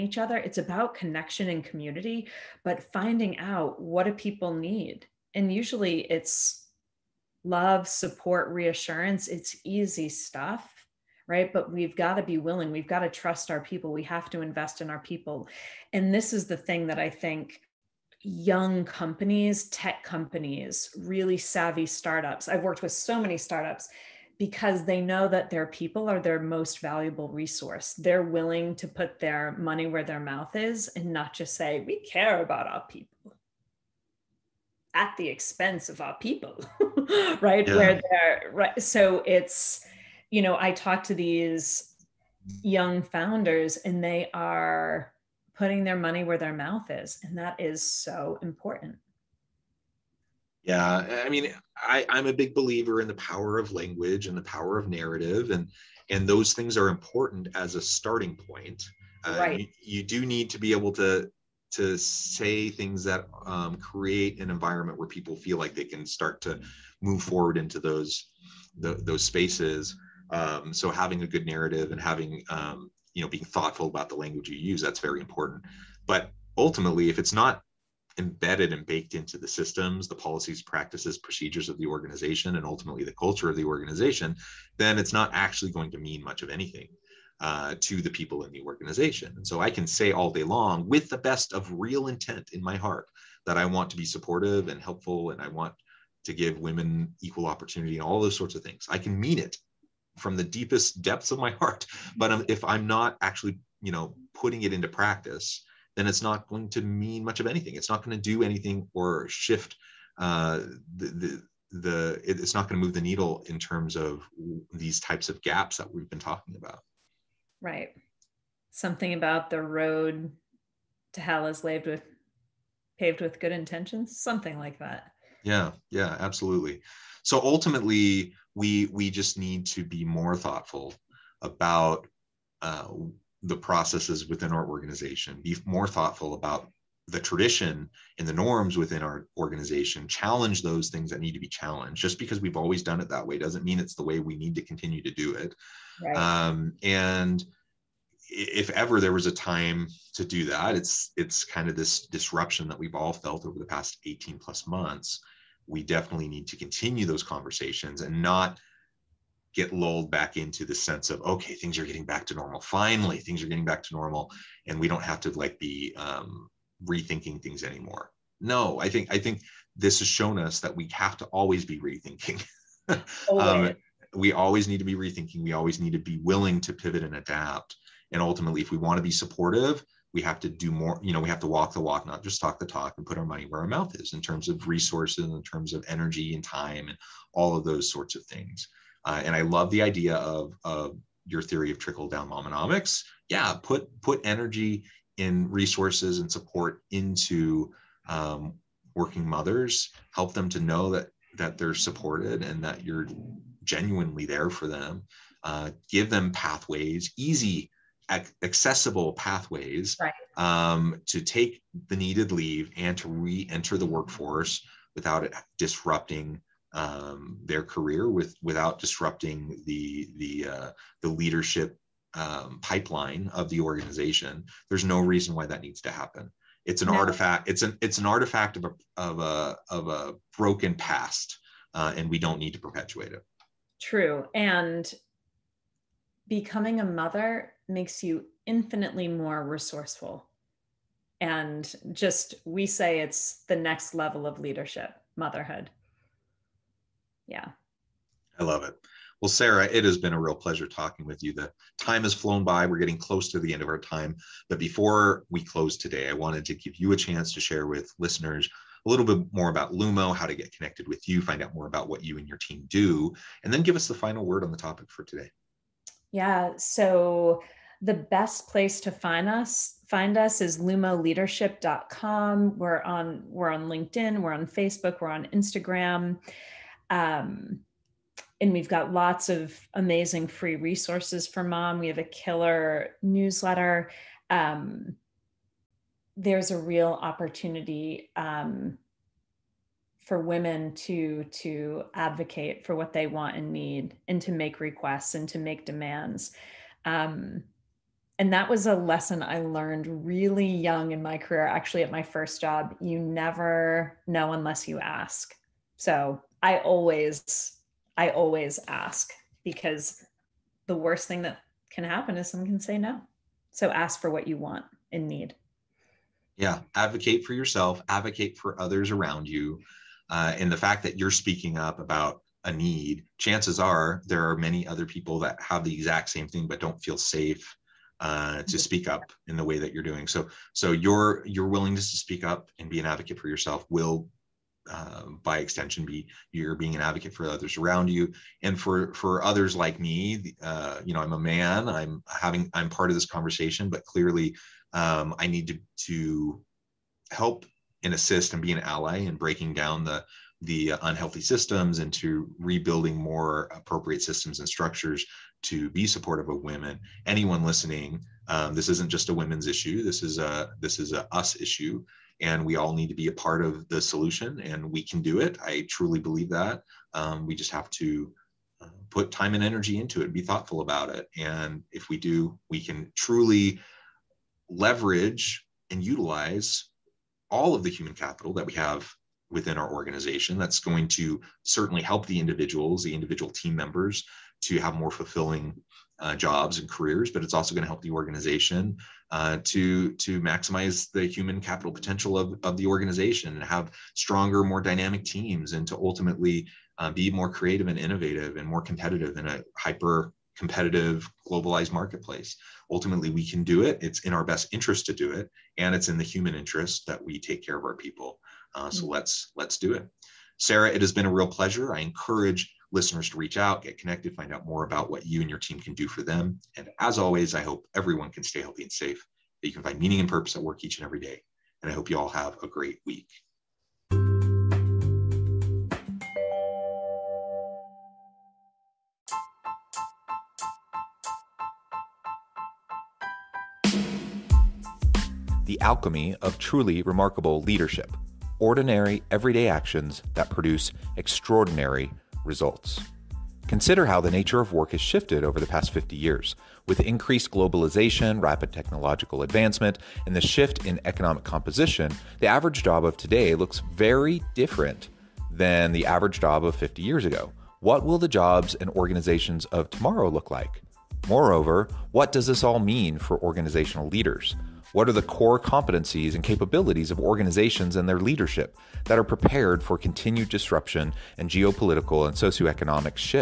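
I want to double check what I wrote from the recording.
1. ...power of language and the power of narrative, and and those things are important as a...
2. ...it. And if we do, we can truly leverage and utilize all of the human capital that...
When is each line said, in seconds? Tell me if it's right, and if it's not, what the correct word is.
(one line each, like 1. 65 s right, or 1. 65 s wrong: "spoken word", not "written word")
1. 53 s right
2. 370 s right.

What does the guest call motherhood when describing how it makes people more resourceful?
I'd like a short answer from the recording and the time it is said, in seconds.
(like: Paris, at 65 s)
the next level of leadership, at 243 s.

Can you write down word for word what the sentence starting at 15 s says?
And this is the thing that I think young companies, tech companies, really savvy startups.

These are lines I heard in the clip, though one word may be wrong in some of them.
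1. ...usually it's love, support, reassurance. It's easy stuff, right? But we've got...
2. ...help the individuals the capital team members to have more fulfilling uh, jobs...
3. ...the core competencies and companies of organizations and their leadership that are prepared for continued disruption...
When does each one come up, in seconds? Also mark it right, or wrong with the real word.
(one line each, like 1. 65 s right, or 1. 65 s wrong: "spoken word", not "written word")
1. 5 s right
2. 381 s wrong: "individual", not "capital"
3. 464 s wrong: "capabilities", not "companies".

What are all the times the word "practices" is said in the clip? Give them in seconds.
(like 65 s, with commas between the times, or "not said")
80 s, 104 s.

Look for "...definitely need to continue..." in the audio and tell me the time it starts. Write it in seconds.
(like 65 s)
155 s.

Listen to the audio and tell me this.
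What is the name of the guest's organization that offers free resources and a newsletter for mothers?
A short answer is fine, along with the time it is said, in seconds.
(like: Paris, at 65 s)
Lumo, at 259 s.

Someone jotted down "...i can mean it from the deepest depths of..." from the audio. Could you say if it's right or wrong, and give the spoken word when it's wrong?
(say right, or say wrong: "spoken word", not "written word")
right.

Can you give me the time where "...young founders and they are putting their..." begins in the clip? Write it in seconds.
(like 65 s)
42 s.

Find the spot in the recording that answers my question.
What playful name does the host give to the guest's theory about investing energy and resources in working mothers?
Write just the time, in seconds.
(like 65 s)
191 s.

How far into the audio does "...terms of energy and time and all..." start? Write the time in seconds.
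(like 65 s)
185 s.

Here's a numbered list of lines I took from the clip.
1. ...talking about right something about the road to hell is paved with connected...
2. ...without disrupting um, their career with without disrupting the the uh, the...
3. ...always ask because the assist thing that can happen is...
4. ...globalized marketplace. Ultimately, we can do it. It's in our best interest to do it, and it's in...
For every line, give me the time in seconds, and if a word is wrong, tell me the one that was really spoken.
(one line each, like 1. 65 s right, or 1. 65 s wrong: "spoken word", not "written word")
1. 116 s wrong: "paved", not "connected"
2. 214 s right
3. 308 s wrong: "worst", not "assist"
4. 401 s right.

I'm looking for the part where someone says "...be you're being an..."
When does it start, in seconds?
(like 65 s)
335 s.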